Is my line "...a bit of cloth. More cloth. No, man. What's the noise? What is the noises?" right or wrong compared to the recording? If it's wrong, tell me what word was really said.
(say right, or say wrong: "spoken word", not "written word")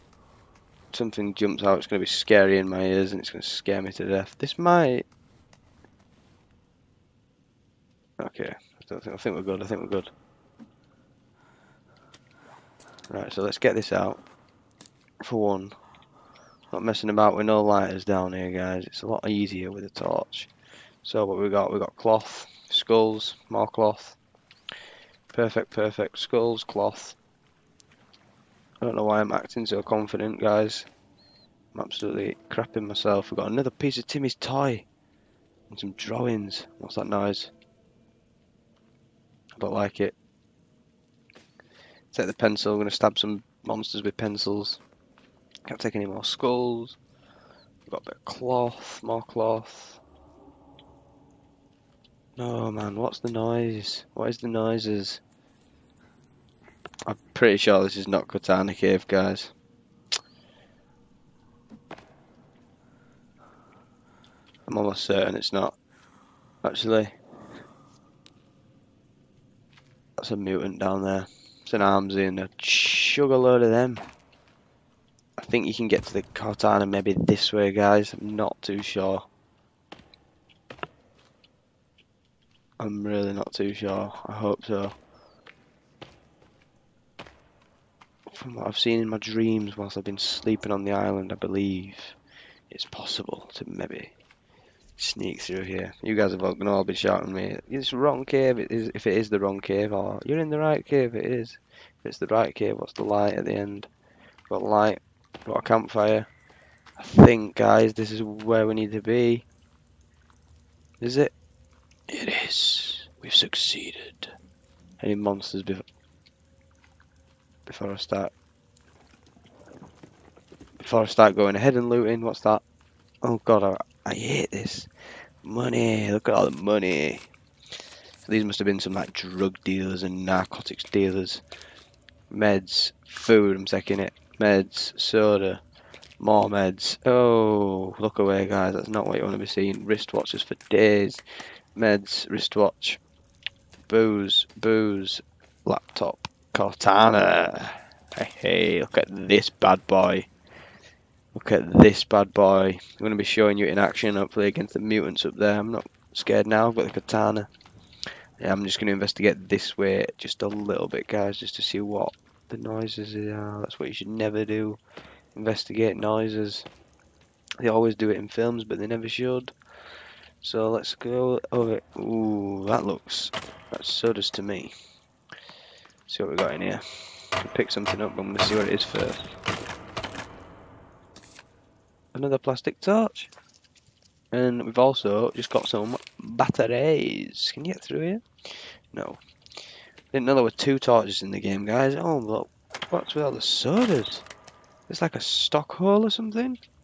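right.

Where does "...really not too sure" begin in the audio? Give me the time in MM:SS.
01:23.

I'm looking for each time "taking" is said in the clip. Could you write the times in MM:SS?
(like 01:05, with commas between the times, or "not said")
02:13.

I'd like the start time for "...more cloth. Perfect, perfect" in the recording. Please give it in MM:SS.
00:23.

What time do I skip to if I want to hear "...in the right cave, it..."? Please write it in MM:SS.
01:40.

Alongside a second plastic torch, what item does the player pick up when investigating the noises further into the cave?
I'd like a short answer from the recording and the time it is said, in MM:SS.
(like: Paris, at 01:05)
Batteries, at 03:06.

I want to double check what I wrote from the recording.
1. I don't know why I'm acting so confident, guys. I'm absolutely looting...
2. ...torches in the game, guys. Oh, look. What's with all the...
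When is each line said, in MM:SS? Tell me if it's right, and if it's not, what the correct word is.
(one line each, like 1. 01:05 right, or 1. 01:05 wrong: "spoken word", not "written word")
1. 00:28 wrong: "crapping", not "looting"
2. 03:10 right.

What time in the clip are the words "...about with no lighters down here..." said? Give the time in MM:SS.
00:17.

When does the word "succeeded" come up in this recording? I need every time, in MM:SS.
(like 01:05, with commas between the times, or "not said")
01:53.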